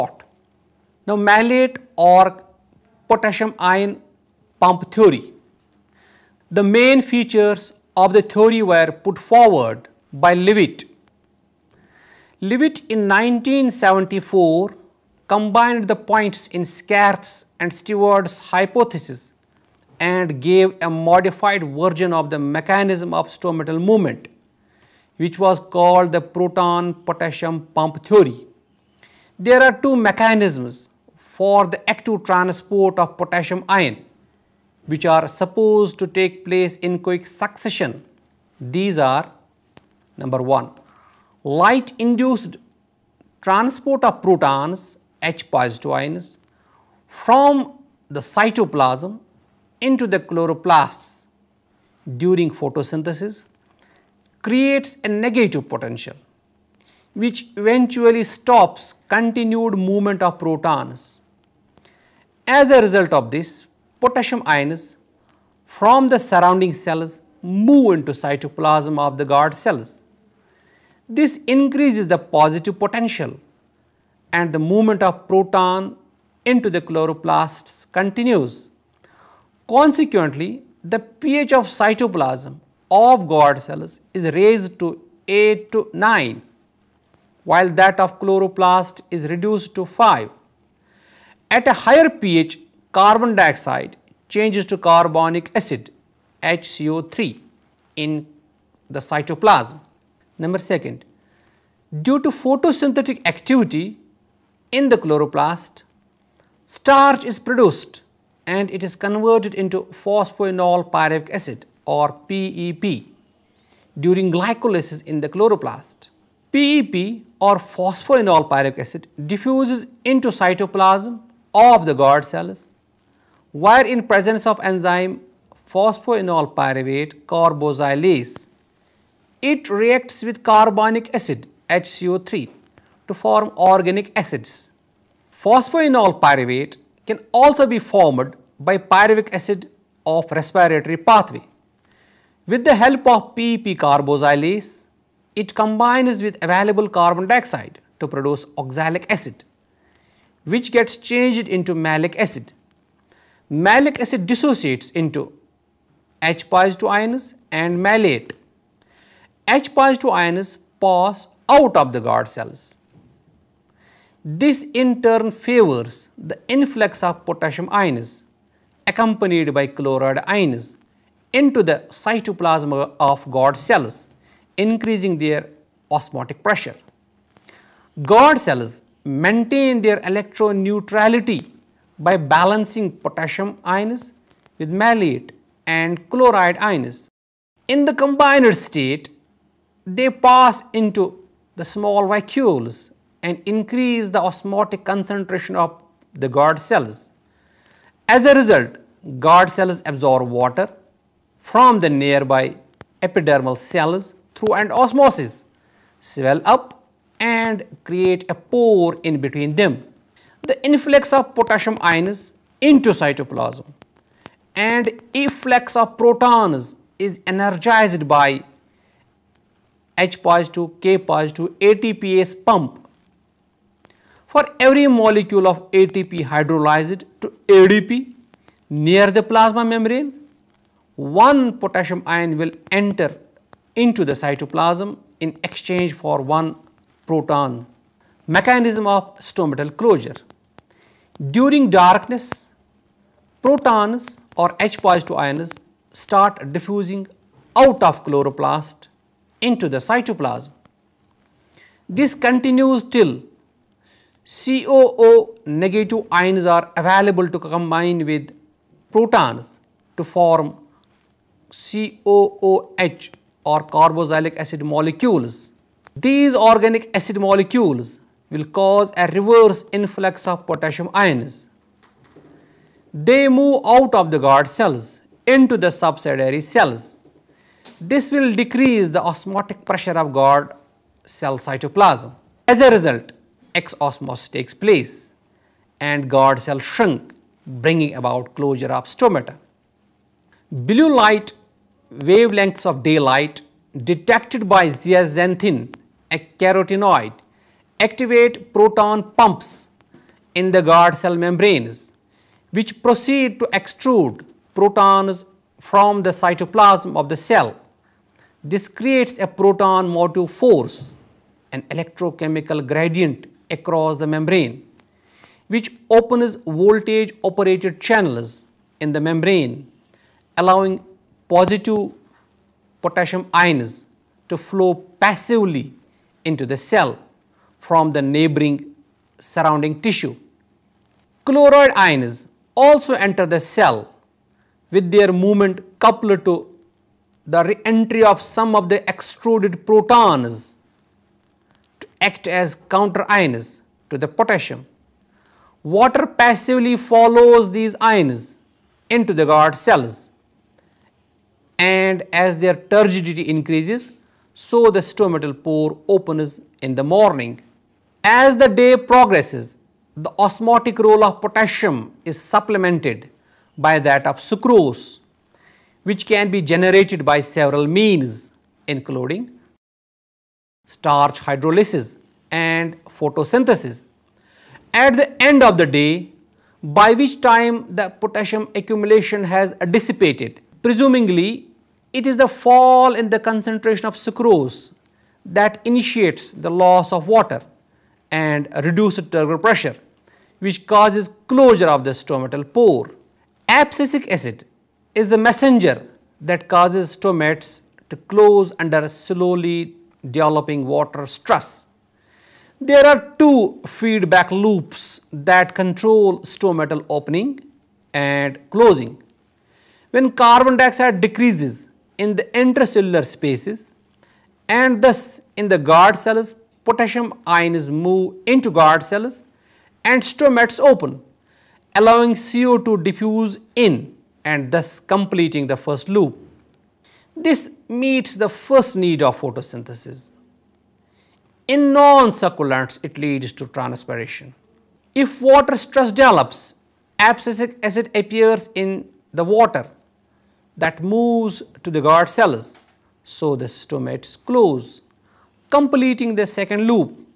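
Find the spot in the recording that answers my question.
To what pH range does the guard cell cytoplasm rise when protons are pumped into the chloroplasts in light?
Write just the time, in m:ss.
1:25.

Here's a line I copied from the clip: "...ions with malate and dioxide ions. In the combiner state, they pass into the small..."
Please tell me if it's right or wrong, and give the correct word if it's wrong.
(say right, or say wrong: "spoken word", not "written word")
wrong: "chloride", not "dioxide".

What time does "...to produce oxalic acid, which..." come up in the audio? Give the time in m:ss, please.
2:27.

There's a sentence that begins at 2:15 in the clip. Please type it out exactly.
Phosphoenol pyruvate can also be formed by pyruvic acid of respiratory pathway.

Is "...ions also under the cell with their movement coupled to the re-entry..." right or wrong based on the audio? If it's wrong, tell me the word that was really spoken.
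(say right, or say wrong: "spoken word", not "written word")
wrong: "enter", not "under".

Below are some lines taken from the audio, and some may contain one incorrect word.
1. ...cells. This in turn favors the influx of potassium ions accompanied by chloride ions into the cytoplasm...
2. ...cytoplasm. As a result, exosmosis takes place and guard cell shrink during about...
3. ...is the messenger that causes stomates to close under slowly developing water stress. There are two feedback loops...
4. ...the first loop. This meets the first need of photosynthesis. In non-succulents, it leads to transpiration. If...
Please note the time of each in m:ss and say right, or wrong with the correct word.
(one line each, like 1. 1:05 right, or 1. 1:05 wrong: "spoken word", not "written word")
1. 2:42 right
2. 4:41 wrong: "bringing", not "during"
3. 6:34 right
4. 7:05 right.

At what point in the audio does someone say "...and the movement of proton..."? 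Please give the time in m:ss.
1:14.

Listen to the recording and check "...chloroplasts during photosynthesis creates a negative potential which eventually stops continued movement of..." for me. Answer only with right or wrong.
right.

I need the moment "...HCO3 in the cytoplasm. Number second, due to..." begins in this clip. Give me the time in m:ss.
1:36.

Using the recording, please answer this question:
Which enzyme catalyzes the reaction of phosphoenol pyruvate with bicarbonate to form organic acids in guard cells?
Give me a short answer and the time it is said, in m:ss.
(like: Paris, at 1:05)
phosphoenol pyruvate carboxylase, at 2:05.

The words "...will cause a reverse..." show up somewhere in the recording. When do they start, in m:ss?
4:28.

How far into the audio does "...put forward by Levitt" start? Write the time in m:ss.
0:09.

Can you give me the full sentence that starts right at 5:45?
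Water passively follows these ions into the guard cells and as their turgidity increases, so the stomatal pore opens in the morning.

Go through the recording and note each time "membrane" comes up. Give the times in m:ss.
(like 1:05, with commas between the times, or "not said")
3:49, 5:01, 5:14, 5:18.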